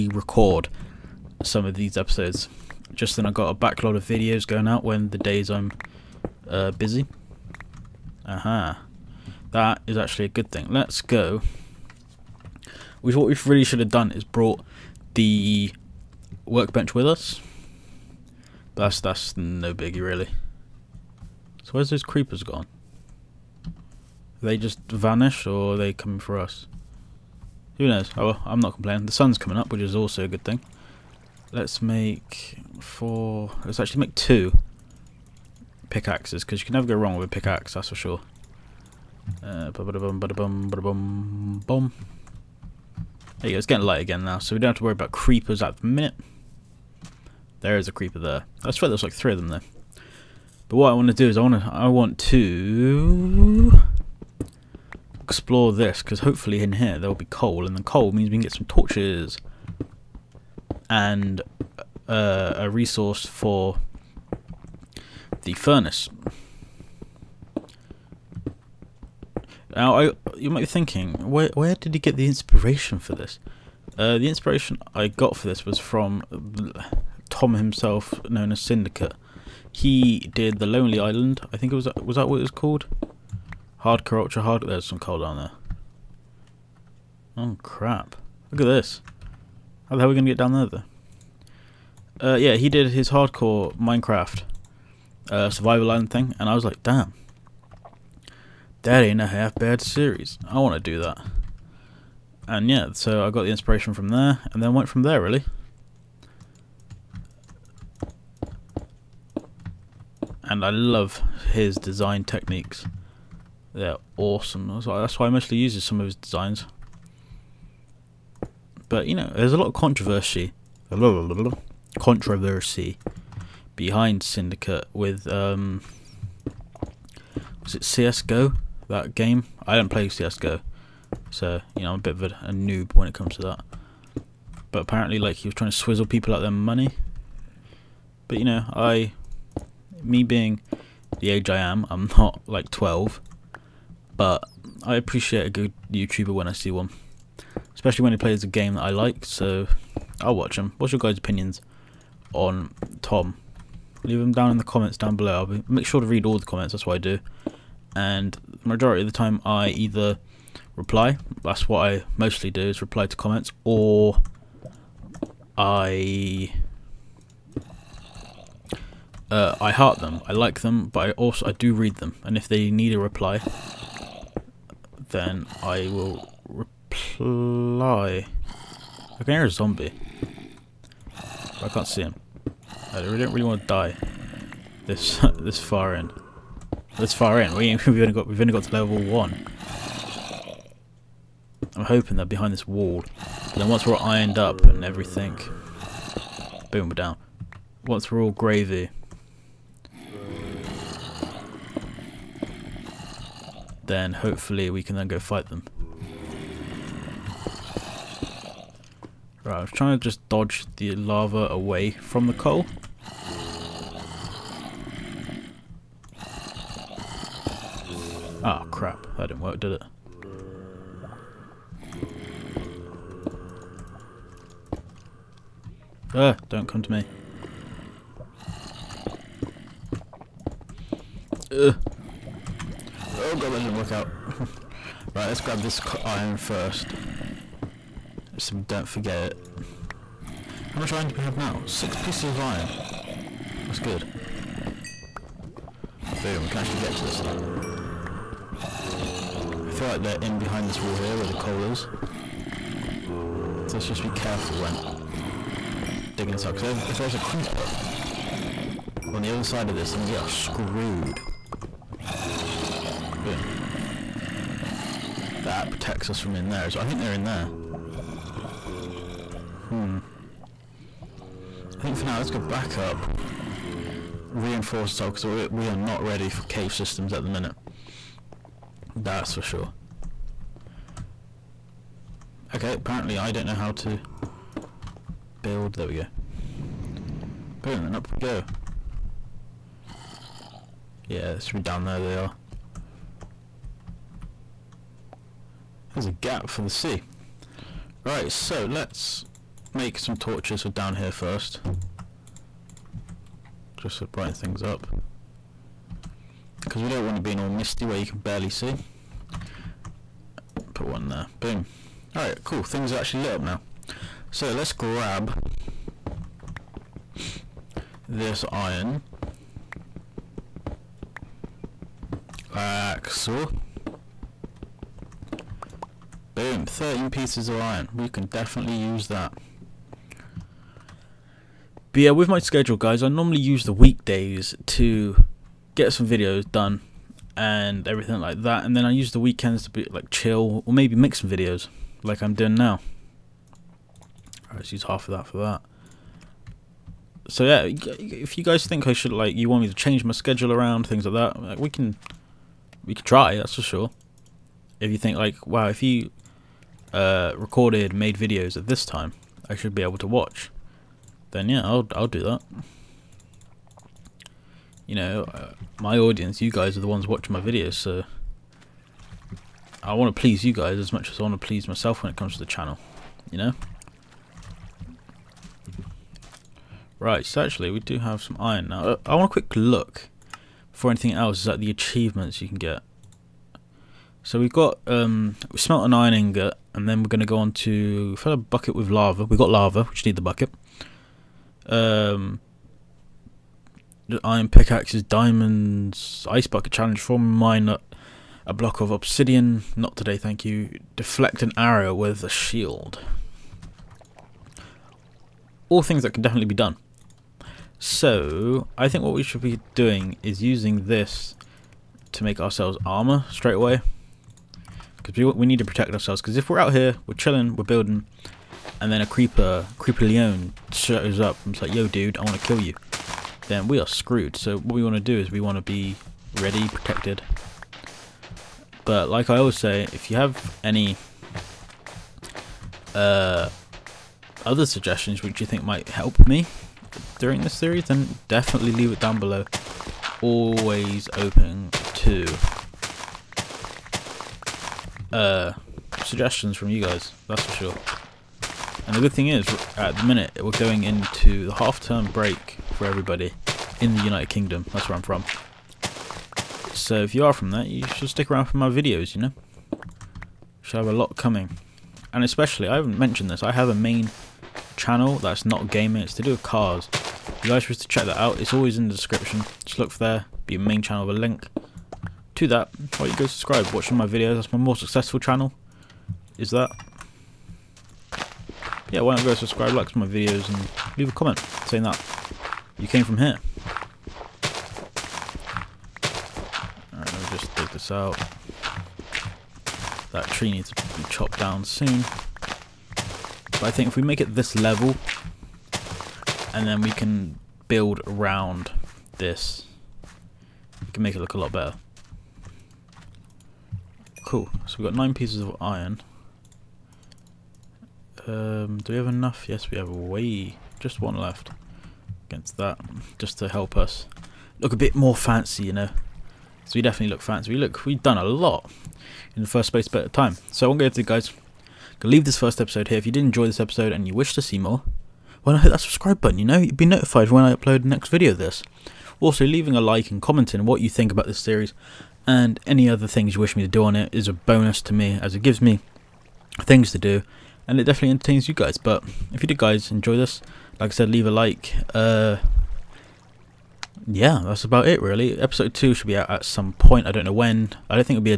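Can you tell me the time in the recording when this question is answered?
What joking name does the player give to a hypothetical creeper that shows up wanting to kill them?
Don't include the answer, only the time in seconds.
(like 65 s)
419 s.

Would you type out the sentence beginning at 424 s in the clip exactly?
So what we want to do is we want to be ready, protected.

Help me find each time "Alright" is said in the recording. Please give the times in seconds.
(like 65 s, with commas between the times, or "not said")
312 s, 486 s.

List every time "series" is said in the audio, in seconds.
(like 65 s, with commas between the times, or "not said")
99 s, 437 s, 531 s.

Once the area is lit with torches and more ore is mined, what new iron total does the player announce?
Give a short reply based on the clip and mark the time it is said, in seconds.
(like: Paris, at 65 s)
13, at 326 s.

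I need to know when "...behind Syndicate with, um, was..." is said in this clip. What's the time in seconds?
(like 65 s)
123 s.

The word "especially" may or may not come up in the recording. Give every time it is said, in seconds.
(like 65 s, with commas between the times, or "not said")
147 s, 462 s.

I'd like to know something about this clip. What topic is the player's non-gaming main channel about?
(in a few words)
cars.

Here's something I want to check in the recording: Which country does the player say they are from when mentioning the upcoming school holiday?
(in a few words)
United Kingdom.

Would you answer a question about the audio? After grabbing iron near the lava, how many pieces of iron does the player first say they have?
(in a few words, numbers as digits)
6.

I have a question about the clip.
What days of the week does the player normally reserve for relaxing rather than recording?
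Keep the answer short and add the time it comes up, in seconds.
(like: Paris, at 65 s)
weekends, at 339 s.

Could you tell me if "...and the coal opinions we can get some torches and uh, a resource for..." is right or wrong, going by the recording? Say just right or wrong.
wrong.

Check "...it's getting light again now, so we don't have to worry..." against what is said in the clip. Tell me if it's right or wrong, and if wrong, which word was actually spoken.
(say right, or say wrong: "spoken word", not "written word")
right.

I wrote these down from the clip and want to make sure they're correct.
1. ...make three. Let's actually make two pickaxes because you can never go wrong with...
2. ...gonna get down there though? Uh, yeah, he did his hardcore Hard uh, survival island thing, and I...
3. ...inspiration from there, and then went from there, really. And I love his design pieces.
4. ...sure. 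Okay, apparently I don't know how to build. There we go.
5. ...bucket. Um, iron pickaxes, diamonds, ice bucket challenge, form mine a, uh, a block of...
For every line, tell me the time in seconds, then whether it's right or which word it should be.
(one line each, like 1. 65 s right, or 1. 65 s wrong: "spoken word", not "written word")
1. 31 s wrong: "four", not "three"
2. 90 s wrong: "Minecraft", not "Hard"
3. 103 s wrong: "techniques", not "pieces"
4. 279 s right
5. 390 s right.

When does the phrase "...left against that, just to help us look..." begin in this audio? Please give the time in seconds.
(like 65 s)
511 s.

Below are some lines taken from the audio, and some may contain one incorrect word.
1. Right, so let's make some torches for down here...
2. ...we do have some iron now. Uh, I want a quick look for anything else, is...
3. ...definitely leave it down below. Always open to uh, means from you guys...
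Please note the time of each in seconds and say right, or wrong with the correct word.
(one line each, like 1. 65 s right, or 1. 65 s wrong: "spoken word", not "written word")
1. 298 s right
2. 377 s right
3. 438 s wrong: "suggestions", not "means".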